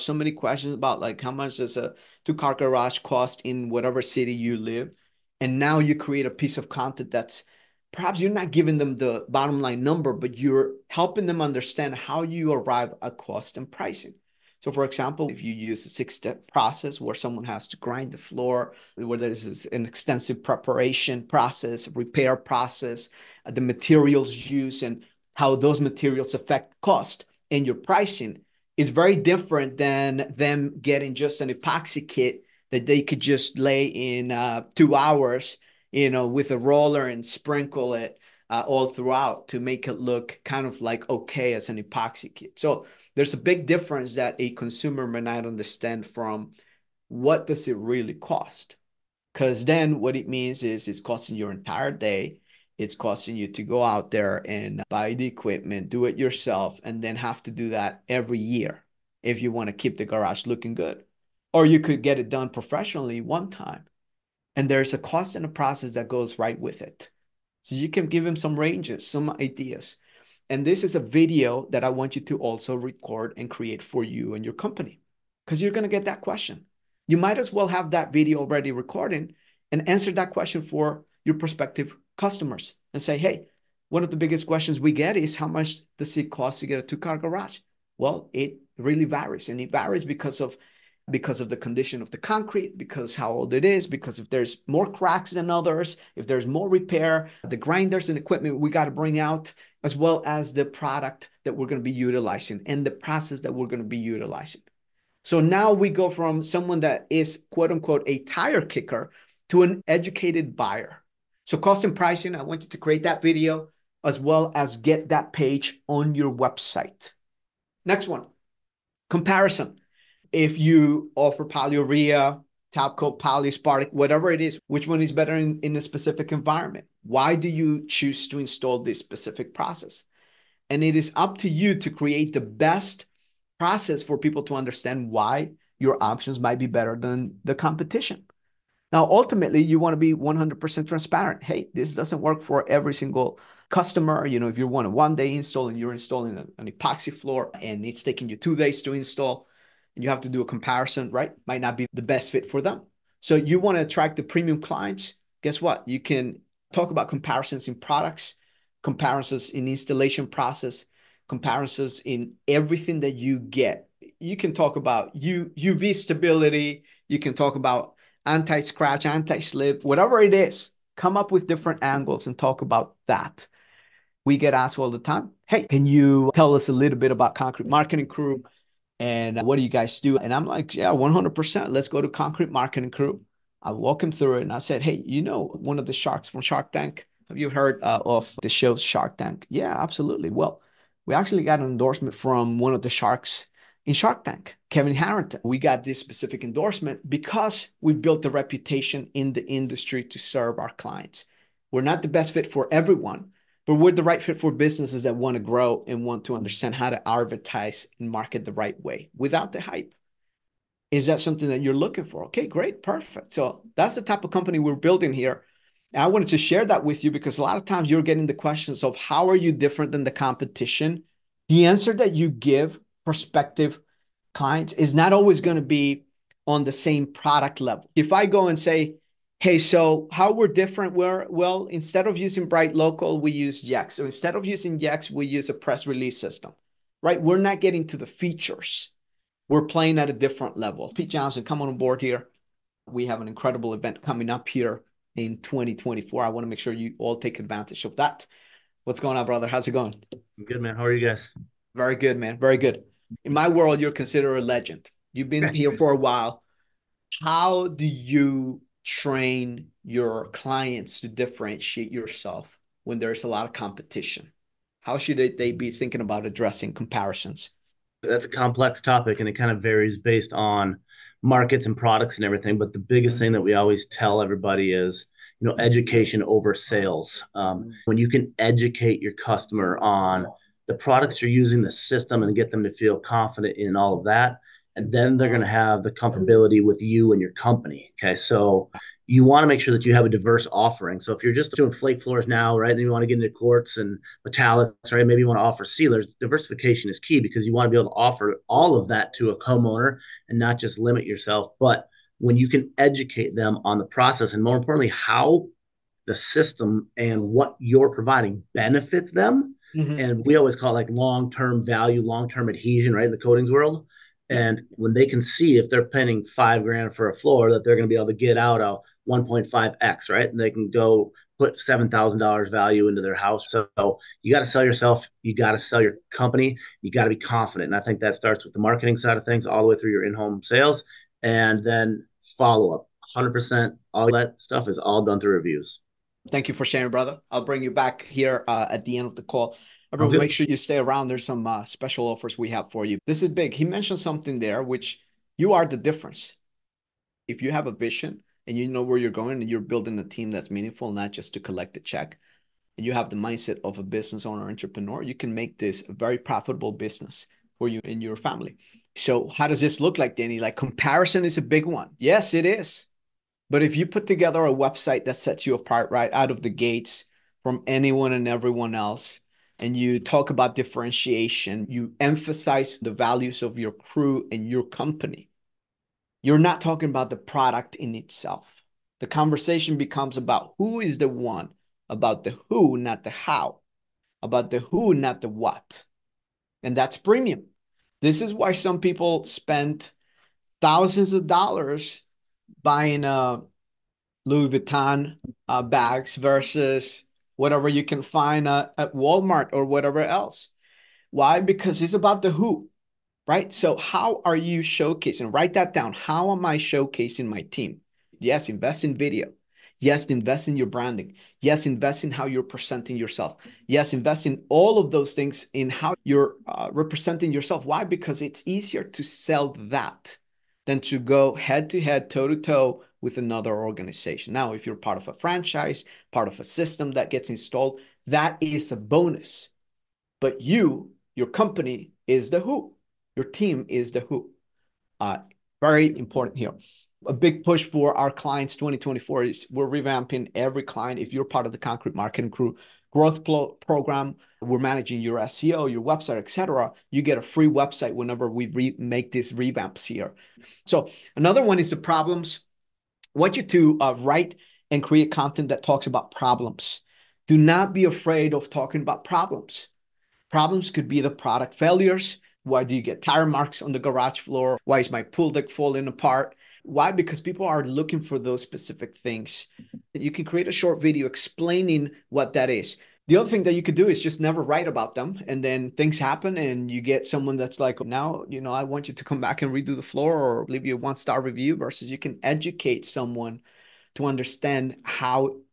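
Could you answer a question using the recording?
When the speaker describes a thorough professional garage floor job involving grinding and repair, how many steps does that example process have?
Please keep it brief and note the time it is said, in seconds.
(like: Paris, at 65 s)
6, at 15 s.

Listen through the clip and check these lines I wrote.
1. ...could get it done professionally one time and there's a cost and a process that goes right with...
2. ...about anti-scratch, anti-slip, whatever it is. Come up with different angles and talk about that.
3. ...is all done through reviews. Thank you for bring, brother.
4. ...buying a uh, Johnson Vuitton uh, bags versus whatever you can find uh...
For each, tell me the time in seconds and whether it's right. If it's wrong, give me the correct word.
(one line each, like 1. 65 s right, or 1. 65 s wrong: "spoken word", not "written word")
1. 61 s right
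2. 167 s right
3. 334 s wrong: "sharing", not "bring"
4. 392 s wrong: "Louis", not "Johnson".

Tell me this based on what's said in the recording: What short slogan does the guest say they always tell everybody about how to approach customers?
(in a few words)
Education over sales.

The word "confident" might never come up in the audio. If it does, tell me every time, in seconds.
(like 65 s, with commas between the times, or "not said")
282 s, 327 s.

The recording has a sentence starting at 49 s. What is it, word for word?
Because then what it means is it's costing your entire day.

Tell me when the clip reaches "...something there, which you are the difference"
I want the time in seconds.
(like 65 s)
344 s.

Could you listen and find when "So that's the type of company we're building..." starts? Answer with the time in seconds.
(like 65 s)
213 s.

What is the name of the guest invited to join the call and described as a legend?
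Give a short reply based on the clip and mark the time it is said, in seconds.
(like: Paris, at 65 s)
Pete Johnson, at 240 s.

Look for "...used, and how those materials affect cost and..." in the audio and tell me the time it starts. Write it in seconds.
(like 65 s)
24 s.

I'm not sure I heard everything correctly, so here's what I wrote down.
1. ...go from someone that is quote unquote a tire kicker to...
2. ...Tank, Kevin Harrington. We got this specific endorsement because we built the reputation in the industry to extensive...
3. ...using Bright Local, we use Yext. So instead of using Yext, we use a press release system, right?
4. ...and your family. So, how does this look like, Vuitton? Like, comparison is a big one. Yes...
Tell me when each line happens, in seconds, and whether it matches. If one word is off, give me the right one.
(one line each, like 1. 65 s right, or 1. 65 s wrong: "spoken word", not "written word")
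1. 105 s right
2. 194 s wrong: "serve", not "extensive"
3. 232 s right
4. 357 s wrong: "Danny", not "Vuitton".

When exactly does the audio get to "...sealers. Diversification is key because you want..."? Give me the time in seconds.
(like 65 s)
295 s.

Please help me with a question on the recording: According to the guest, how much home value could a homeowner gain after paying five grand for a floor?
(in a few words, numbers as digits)
$7,000.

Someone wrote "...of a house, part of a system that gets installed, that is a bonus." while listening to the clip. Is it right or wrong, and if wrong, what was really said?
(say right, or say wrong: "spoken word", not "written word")
wrong: "franchise", not "house".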